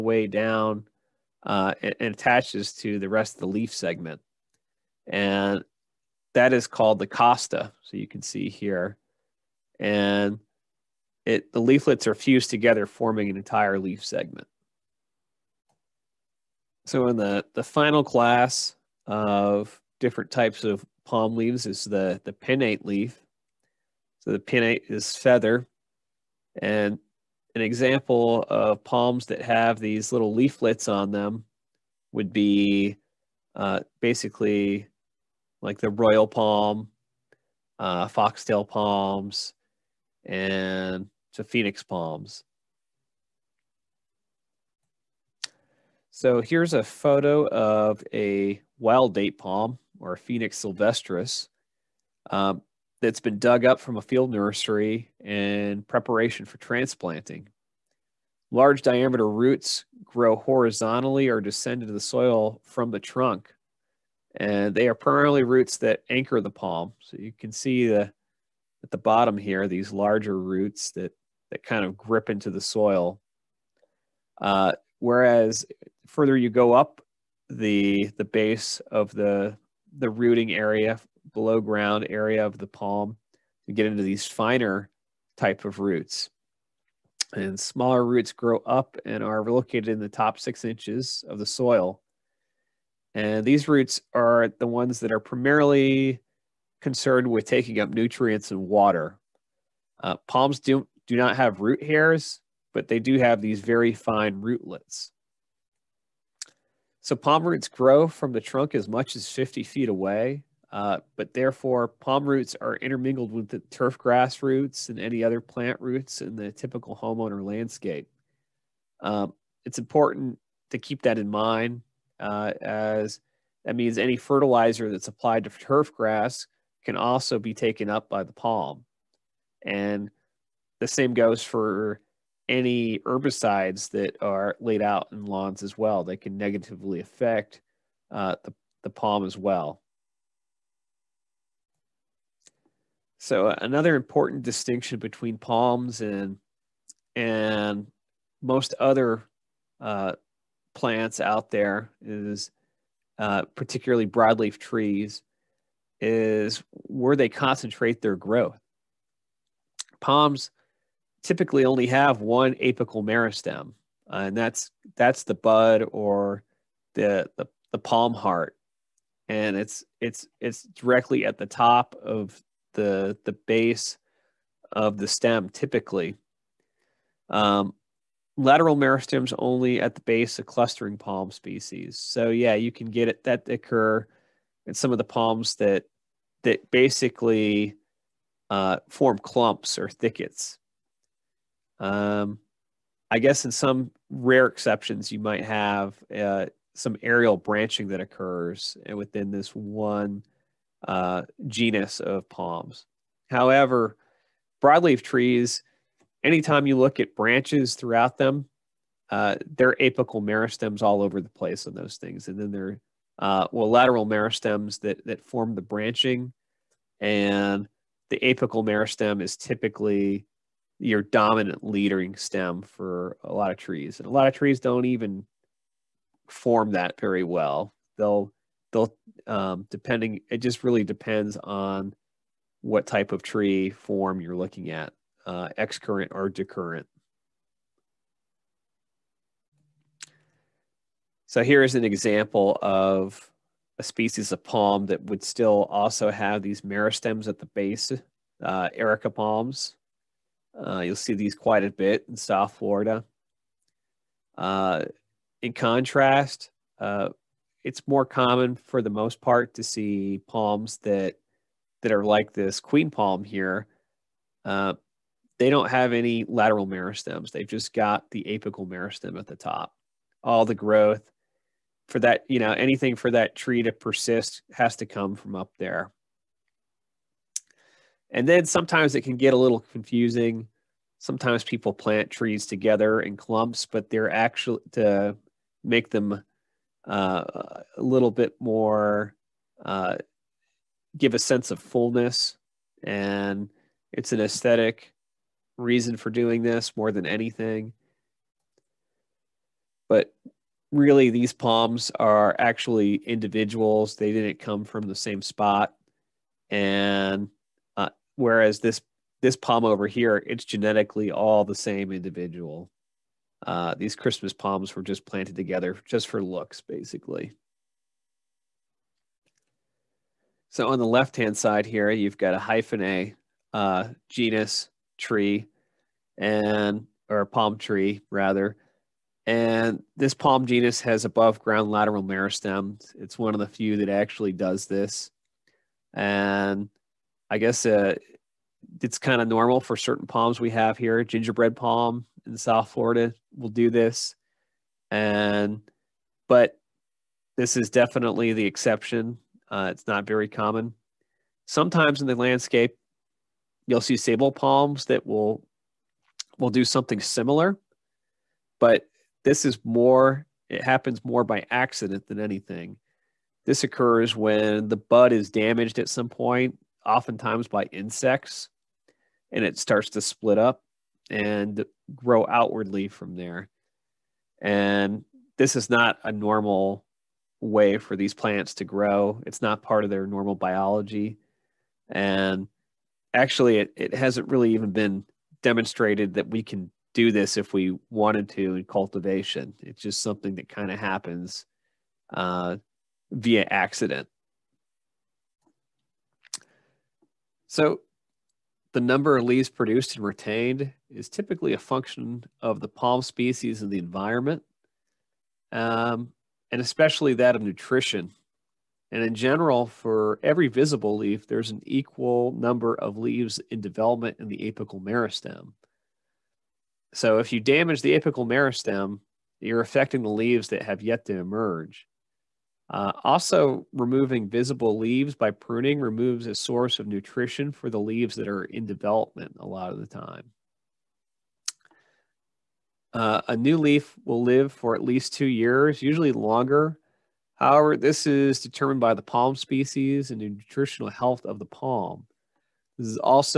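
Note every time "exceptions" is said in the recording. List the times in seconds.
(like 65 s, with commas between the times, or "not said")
194 s, 348 s.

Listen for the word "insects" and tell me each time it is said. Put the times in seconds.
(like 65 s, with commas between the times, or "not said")
367 s.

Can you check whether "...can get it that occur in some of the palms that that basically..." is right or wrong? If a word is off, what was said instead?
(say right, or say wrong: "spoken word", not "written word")
right.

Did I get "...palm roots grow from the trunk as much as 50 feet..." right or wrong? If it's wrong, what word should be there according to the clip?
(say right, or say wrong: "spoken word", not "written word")
right.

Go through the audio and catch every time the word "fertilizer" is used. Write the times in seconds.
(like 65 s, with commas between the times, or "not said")
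124 s.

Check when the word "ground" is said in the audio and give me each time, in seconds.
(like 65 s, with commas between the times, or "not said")
81 s, 331 s.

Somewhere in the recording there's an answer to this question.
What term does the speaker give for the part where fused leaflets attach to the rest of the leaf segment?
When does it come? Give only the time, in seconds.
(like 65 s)
7 s.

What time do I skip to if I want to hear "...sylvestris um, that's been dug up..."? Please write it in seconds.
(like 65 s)
50 s.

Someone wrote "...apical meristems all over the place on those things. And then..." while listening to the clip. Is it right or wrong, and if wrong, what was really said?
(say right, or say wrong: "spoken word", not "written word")
right.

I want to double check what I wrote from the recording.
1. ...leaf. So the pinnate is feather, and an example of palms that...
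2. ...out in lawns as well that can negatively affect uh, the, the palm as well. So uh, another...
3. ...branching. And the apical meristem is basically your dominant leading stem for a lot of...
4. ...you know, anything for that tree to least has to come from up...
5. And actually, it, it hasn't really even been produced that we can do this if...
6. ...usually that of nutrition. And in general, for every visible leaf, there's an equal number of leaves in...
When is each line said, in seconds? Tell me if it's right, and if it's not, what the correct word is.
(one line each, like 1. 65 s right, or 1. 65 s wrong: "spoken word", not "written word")
1. 22 s right
2. 134 s right
3. 215 s wrong: "typically", not "basically"
4. 272 s wrong: "persist", not "least"
5. 381 s wrong: "demonstrated", not "produced"
6. 406 s wrong: "especially", not "usually".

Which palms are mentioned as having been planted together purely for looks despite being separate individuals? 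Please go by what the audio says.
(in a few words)
Christmas palms.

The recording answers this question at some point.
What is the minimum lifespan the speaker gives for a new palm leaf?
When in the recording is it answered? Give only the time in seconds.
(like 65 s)
435 s.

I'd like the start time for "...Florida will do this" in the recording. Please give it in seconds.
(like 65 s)
342 s.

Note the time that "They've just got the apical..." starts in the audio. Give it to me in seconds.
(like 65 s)
267 s.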